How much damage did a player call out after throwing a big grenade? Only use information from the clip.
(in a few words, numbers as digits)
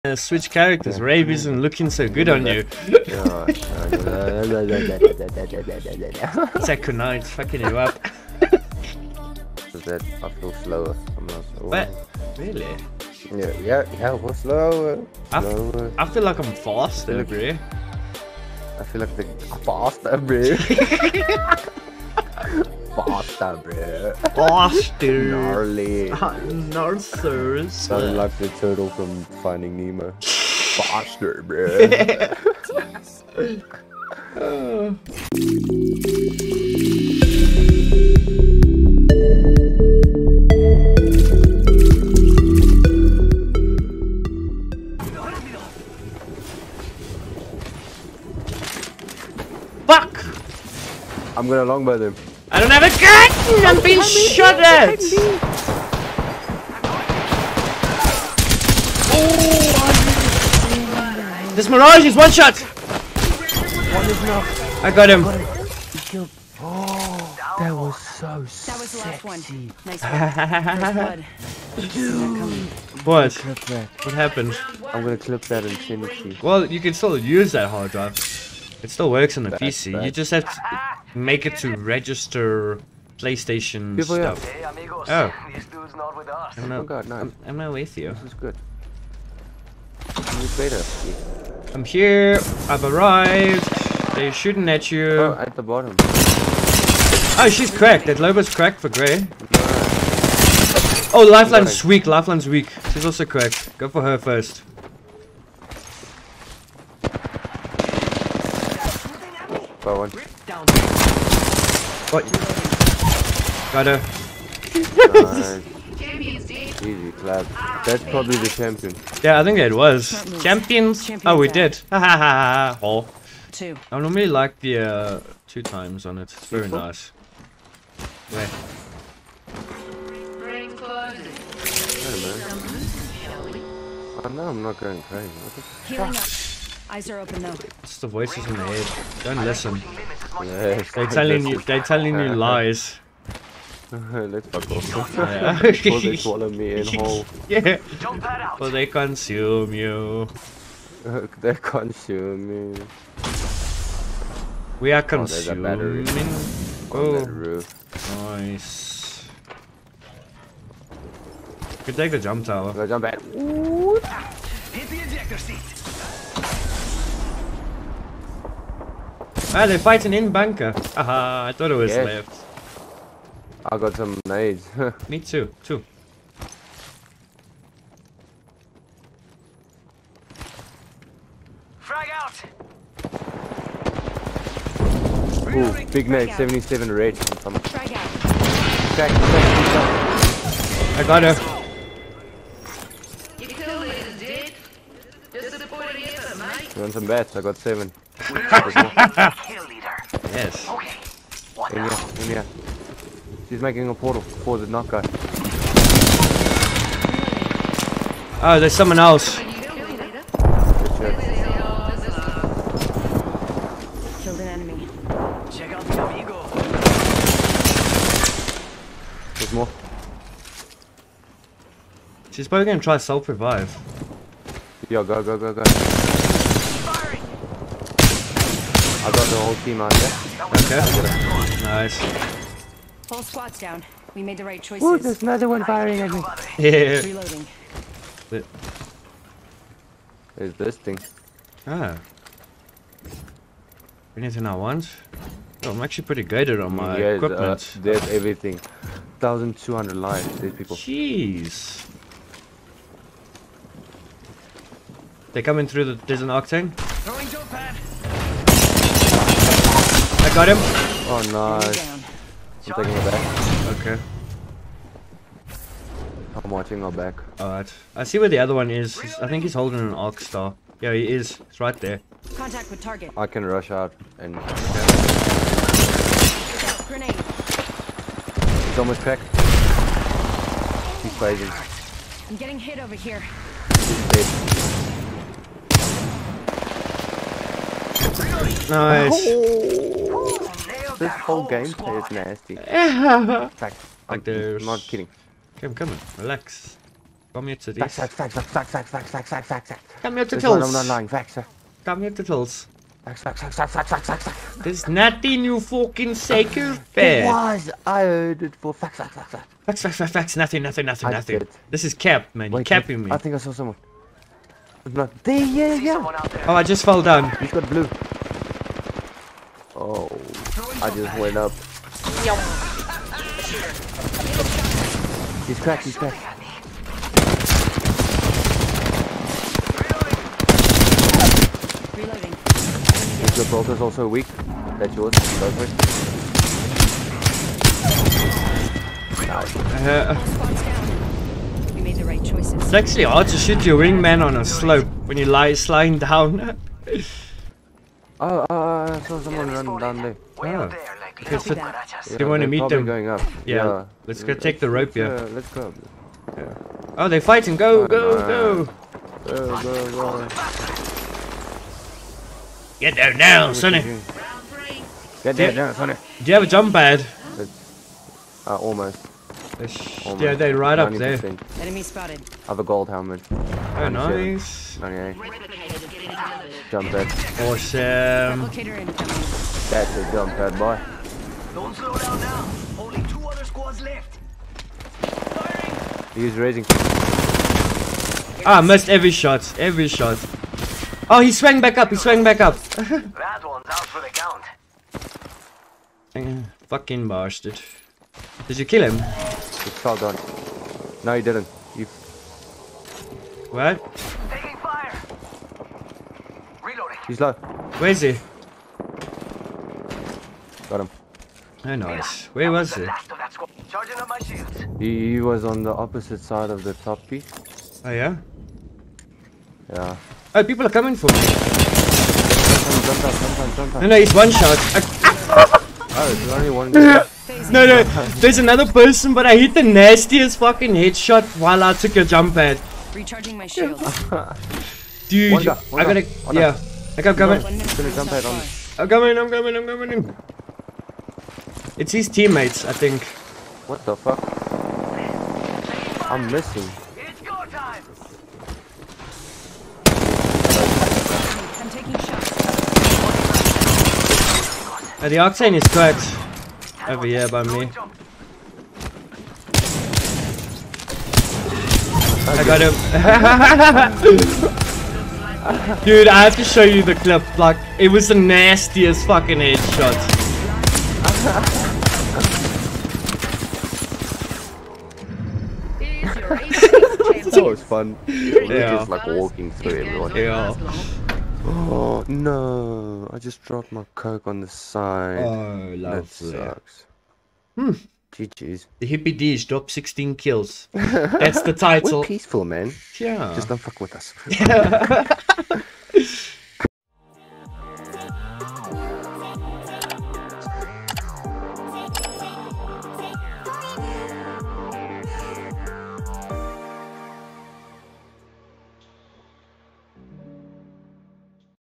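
77.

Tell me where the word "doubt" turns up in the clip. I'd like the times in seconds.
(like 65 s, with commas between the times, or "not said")
not said.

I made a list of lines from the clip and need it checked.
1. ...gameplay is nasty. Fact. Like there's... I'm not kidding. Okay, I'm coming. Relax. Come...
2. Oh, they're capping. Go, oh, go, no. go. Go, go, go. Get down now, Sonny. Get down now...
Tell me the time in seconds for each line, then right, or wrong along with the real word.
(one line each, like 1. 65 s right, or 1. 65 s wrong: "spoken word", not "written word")
1. 291 s right
2. 356 s wrong: "fighting", not "capping".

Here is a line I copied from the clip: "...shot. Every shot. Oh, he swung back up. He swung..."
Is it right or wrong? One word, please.
right.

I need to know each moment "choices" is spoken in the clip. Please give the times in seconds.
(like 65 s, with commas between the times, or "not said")
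234 s, 342 s.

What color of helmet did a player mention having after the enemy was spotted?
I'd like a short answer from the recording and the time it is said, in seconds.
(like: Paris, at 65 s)
gold, at 372 s.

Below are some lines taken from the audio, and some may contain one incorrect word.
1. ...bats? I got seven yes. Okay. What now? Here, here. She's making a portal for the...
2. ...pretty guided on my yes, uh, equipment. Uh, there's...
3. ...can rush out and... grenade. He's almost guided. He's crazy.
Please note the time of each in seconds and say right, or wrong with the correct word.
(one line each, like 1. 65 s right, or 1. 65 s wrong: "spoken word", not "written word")
1. 197 s right
2. 246 s right
3. 273 s wrong: "packed", not "guided".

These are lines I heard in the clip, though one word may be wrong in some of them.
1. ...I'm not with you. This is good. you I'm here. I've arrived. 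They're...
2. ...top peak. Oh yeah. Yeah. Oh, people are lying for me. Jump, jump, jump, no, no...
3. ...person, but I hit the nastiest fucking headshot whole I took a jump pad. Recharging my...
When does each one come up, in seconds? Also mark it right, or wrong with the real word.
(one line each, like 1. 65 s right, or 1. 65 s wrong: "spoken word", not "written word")
1. 87 s right
2. 416 s wrong: "coming", not "lying"
3. 428 s wrong: "while", not "whole".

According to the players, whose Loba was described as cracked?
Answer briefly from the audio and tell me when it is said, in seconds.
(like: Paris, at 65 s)
Grey, at 98 s.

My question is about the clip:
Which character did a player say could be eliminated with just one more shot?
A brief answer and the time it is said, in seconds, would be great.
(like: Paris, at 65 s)
Mirage, at 61 s.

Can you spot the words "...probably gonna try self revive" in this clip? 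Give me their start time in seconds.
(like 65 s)
222 s.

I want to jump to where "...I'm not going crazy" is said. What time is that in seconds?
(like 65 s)
134 s.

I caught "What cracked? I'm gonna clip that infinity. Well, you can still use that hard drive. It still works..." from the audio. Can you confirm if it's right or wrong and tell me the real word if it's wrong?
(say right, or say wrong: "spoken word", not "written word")
wrong: "happened", not "cracked".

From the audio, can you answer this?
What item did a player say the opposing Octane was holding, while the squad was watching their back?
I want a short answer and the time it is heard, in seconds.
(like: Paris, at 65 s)
Arc Star, at 269 s.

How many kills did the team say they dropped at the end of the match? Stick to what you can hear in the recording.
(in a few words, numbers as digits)
16.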